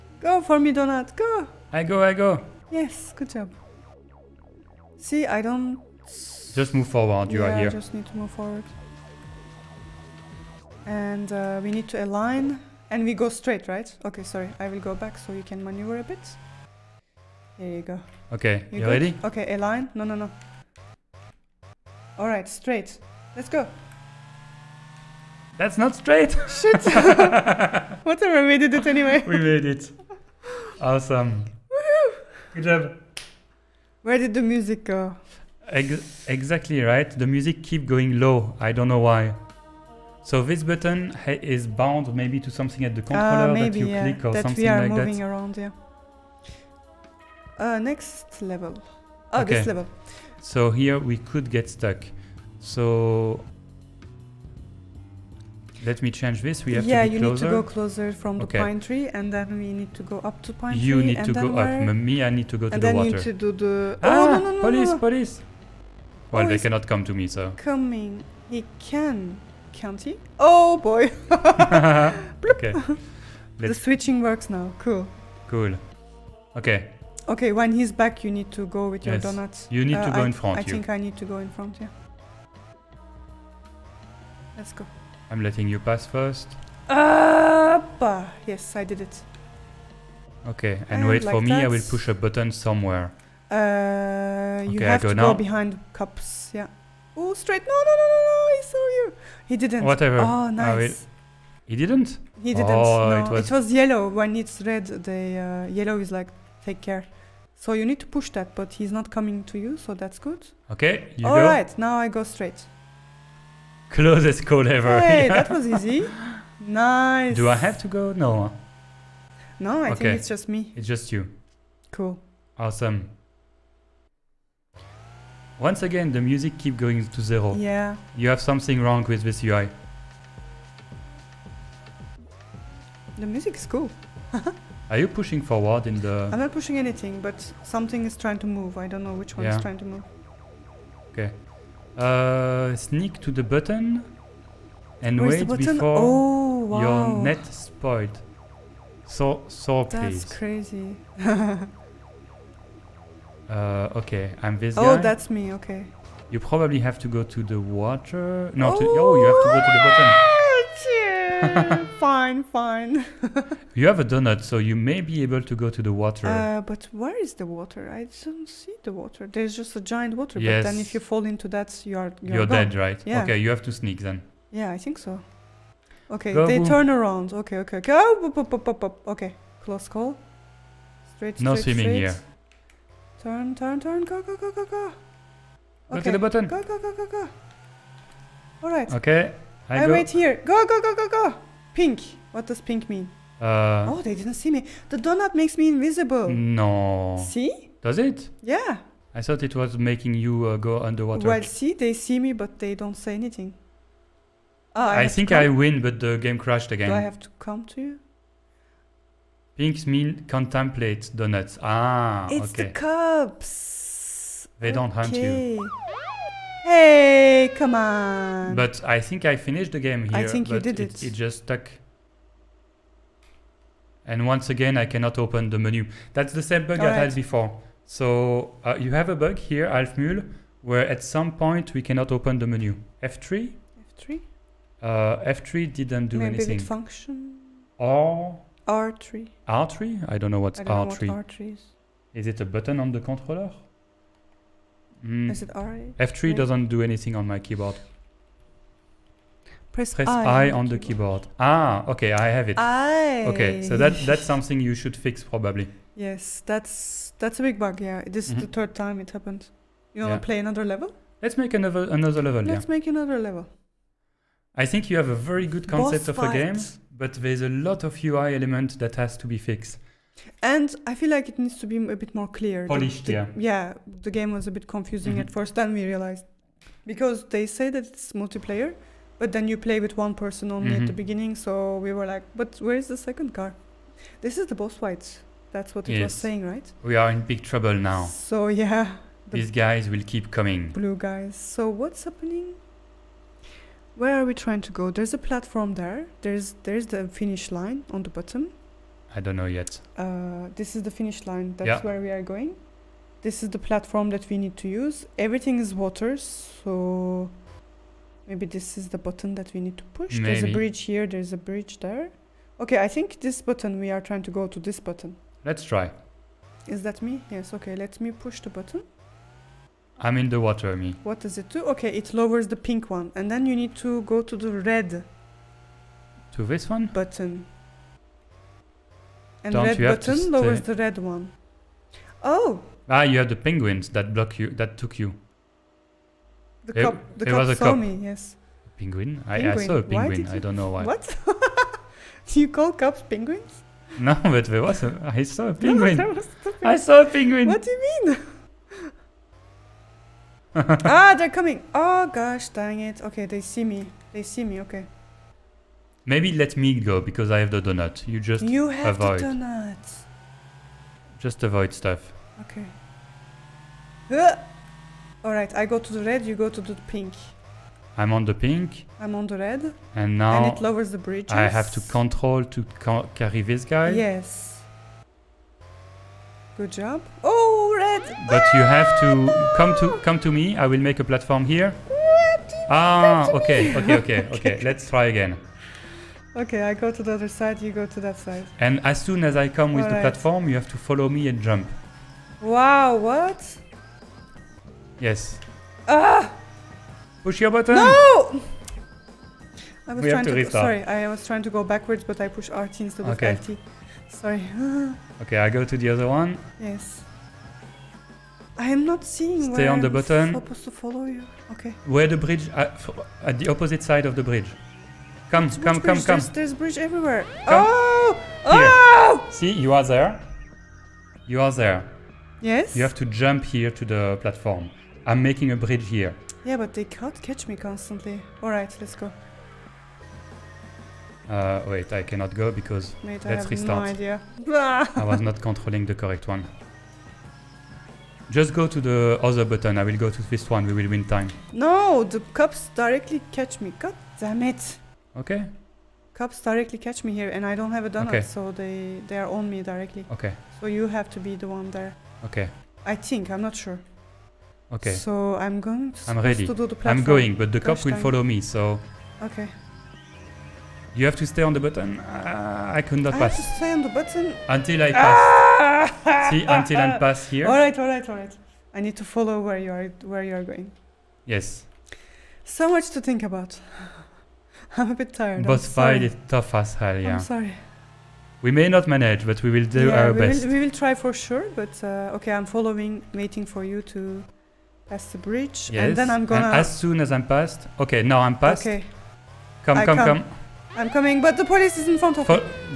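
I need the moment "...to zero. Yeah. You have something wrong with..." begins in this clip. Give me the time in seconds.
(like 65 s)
127 s.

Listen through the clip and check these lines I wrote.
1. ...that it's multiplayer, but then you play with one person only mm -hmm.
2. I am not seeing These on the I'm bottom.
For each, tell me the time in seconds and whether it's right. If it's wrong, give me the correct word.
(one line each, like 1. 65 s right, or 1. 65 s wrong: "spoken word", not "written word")
1. 277 s right
2. 408 s wrong: "Stay", not "These".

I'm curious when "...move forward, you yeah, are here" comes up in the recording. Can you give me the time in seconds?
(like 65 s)
6 s.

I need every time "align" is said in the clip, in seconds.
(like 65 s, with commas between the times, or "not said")
12 s, 19 s.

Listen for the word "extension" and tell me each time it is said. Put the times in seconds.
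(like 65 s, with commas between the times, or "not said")
not said.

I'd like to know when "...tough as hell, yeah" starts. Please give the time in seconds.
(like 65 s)
476 s.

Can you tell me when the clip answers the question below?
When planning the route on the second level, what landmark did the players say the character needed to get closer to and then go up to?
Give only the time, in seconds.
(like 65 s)
58 s.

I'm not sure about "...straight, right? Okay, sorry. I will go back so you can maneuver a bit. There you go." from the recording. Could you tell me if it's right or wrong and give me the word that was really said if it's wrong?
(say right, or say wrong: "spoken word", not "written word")
right.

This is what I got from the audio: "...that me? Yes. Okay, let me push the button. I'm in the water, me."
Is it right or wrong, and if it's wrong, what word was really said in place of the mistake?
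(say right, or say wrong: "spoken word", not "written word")
right.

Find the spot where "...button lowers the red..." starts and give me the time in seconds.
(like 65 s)
329 s.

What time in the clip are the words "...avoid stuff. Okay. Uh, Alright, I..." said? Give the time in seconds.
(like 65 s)
361 s.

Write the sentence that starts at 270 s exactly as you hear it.
And I feel like it needs to be a bit more clear.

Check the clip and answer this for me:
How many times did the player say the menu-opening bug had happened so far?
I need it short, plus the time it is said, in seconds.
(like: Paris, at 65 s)
3, at 258 s.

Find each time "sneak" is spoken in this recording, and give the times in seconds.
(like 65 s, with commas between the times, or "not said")
142 s, 173 s.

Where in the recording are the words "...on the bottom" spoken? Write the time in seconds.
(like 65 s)
297 s.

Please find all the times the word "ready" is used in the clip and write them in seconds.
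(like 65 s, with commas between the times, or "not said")
18 s, 456 s.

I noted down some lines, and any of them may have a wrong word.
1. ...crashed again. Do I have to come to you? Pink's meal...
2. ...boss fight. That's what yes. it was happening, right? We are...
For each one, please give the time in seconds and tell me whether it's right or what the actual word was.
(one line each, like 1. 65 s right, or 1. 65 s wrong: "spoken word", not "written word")
1. 206 s right
2. 284 s wrong: "saying", not "happening".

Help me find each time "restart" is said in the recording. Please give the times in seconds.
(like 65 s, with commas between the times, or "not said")
400 s, 433 s.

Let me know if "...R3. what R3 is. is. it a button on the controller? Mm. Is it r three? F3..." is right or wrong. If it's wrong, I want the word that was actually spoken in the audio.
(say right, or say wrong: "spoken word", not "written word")
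right.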